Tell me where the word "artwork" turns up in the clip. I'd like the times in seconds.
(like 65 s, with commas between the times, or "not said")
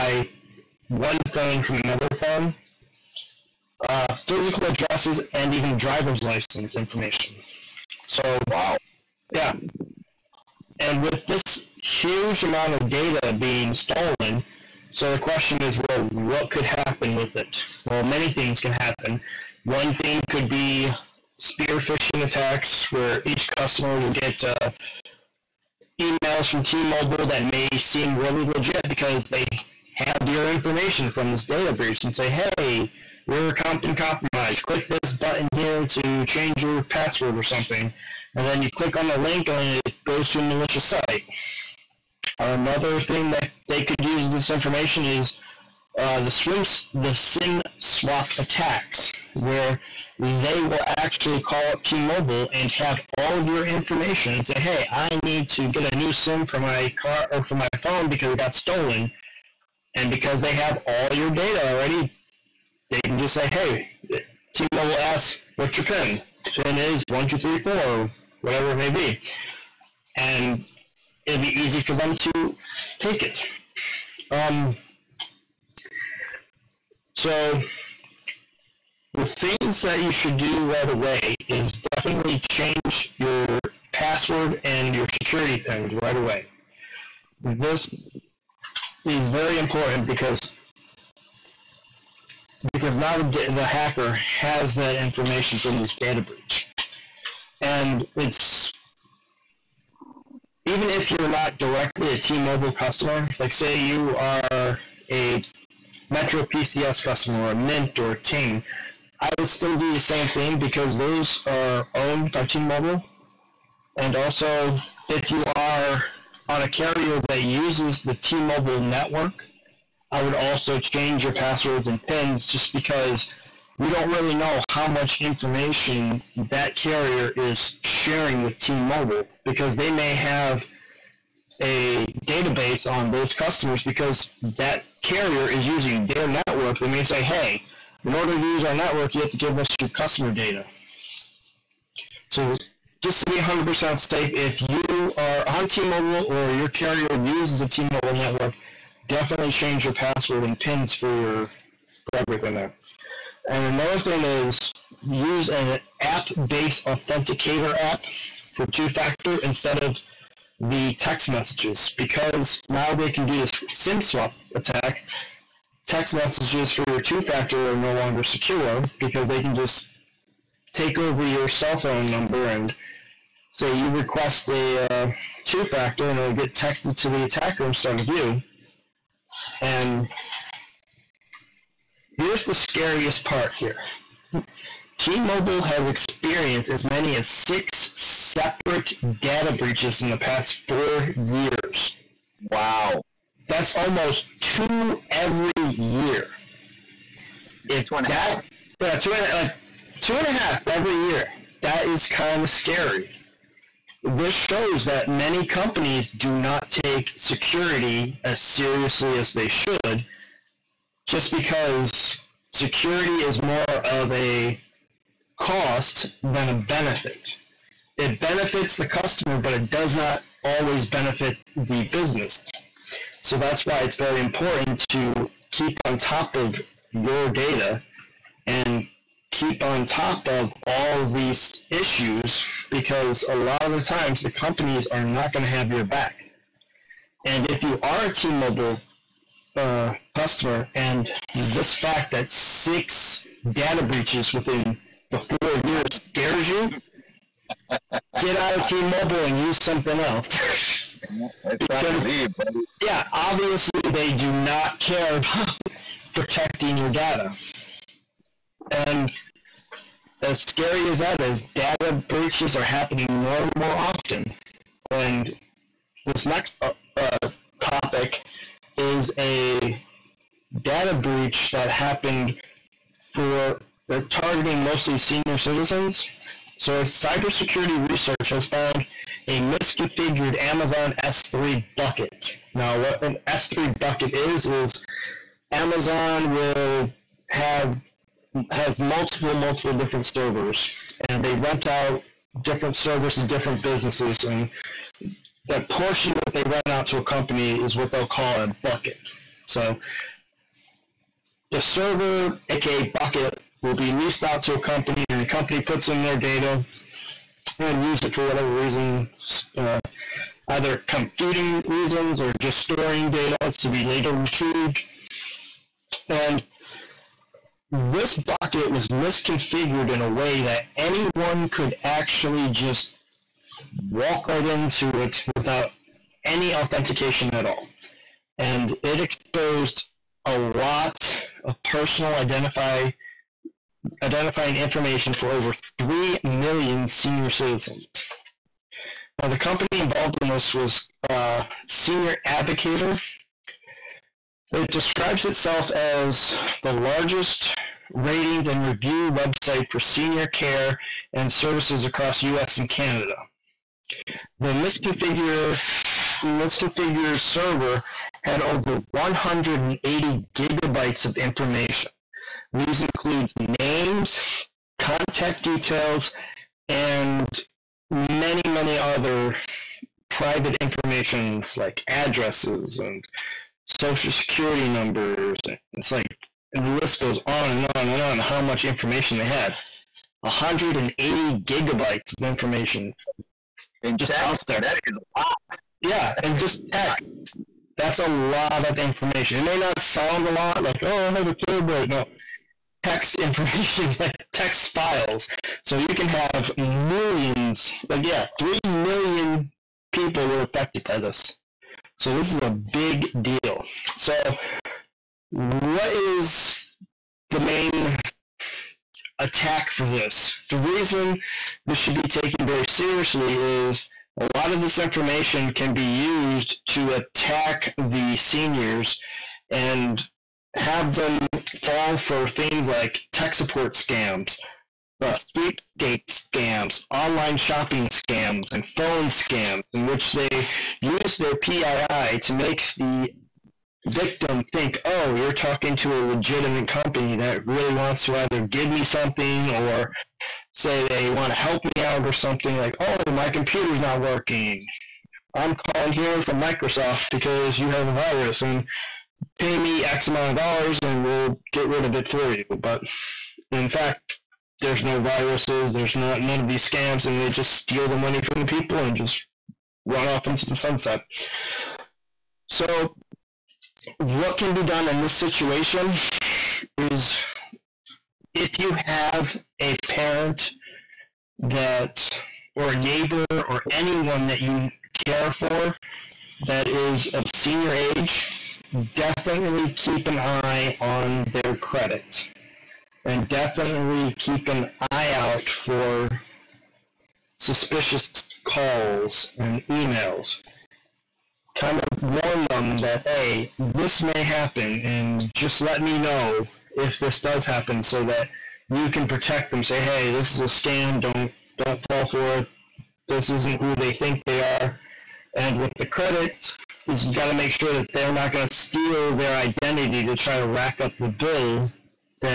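not said.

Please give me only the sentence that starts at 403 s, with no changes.
So, what is the main attack for this?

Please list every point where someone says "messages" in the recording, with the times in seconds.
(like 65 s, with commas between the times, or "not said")
161 s, 166 s.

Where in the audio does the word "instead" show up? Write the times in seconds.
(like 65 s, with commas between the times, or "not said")
159 s, 177 s.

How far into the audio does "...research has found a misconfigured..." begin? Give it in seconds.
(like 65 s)
277 s.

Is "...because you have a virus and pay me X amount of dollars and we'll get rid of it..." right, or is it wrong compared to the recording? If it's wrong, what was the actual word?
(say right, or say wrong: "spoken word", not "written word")
right.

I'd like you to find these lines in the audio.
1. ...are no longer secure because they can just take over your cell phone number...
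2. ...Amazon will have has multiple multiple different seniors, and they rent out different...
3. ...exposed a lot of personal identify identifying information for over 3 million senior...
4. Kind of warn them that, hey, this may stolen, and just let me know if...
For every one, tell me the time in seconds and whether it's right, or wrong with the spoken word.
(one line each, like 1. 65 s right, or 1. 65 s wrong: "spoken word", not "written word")
1. 167 s right
2. 285 s wrong: "servers", not "seniors"
3. 328 s right
4. 491 s wrong: "happen", not "stolen".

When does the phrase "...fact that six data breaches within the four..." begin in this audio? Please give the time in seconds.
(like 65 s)
241 s.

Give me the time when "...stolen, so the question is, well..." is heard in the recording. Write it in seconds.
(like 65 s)
13 s.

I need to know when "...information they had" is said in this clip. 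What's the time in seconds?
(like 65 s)
378 s.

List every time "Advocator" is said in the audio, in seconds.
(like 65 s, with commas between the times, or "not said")
342 s.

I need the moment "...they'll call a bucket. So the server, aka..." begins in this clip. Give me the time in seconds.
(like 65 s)
297 s.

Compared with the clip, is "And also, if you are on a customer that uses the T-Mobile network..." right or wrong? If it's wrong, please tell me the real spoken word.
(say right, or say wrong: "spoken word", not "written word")
wrong: "carrier", not "customer".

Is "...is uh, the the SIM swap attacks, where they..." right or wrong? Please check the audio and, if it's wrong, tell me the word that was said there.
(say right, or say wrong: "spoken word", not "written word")
right.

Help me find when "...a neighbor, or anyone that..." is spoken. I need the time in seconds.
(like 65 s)
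472 s.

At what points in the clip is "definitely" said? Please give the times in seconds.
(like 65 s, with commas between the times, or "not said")
81 s, 149 s, 478 s, 483 s.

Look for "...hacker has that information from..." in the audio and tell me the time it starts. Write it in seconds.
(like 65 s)
93 s.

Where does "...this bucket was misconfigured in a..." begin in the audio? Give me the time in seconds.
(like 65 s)
317 s.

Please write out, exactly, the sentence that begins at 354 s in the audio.
The misconfigure, misconfigured server had over 180 gigabytes of information.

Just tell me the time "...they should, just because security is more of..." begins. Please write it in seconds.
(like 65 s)
209 s.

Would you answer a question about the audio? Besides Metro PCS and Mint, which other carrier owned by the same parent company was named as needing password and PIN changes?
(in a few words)
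Ting.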